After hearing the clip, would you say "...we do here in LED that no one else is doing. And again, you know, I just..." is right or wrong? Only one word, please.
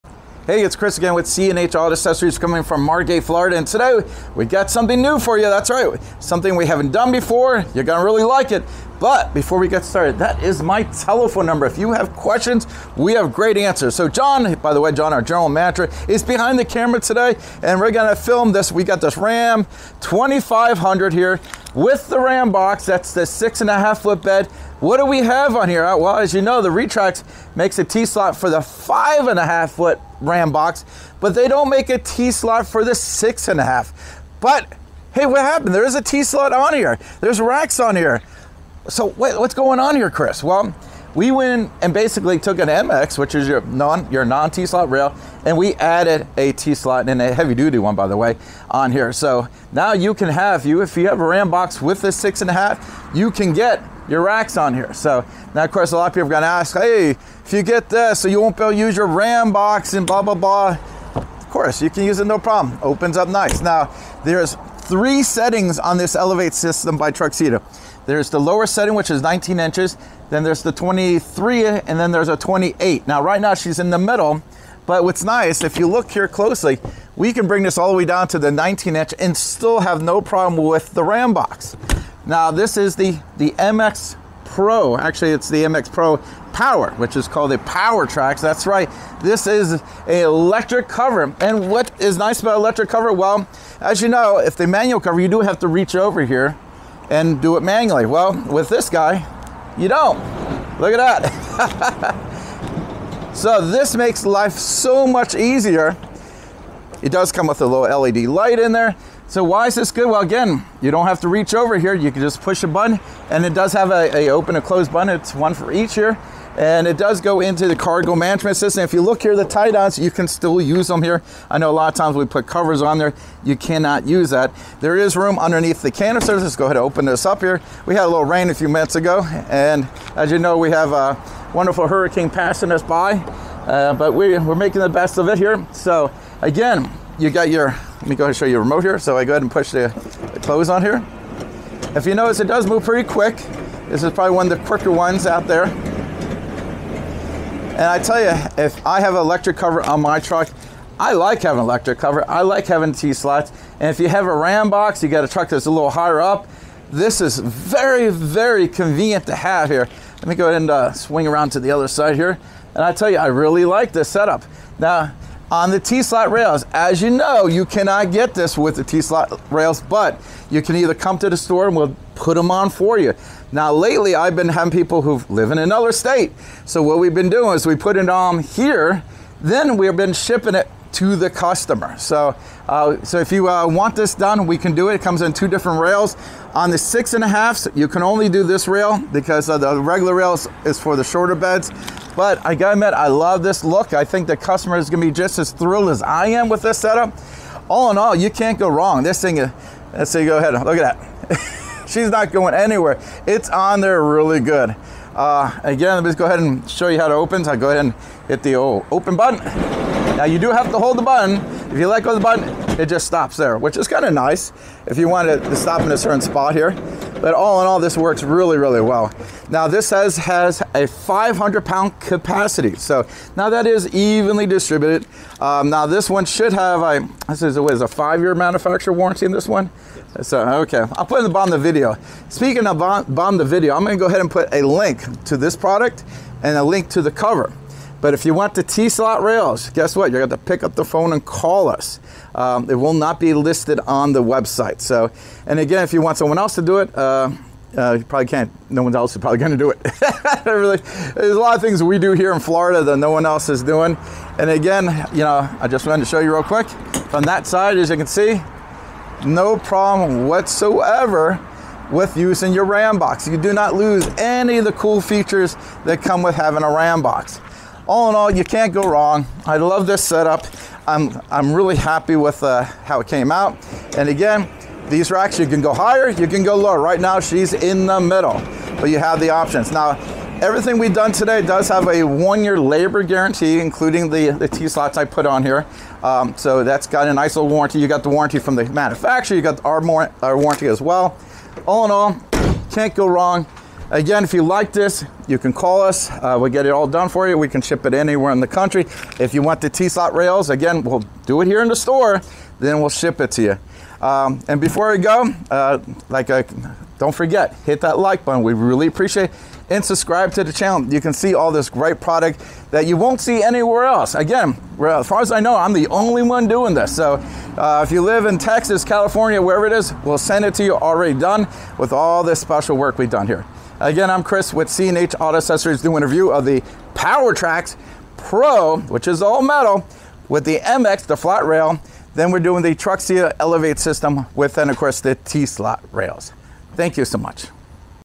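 wrong.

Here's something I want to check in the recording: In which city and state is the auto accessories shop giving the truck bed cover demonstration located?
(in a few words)
Margate, Florida.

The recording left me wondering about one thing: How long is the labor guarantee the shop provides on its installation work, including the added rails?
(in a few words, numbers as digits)
1 year.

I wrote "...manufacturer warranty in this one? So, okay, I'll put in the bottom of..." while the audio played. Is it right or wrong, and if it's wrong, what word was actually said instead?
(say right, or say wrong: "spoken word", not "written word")
right.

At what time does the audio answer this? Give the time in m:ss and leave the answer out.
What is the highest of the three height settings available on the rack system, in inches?
1:12.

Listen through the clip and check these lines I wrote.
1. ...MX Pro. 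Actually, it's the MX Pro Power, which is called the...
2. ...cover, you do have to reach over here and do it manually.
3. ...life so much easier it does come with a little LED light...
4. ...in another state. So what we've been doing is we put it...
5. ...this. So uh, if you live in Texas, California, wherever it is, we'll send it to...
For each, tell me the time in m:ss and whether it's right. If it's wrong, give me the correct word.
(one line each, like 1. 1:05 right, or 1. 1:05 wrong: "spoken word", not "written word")
1. 1:23 right
2. 1:34 right
3. 1:44 right
4. 2:55 right
5. 5:16 right.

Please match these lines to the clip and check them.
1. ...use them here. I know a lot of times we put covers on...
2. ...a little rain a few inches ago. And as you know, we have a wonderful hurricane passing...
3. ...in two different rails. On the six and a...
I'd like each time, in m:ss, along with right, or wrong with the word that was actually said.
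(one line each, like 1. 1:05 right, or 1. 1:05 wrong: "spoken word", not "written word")
1. 2:00 right
2. 2:08 wrong: "minutes", not "inches"
3. 3:05 right.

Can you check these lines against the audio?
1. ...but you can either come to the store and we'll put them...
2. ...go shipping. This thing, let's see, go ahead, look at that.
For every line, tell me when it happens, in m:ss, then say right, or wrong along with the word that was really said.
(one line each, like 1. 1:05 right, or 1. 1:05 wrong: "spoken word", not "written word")
1. 2:49 right
2. 3:18 wrong: "wrong", not "shipping".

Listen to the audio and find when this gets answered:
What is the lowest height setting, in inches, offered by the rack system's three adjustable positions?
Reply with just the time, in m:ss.
1:09.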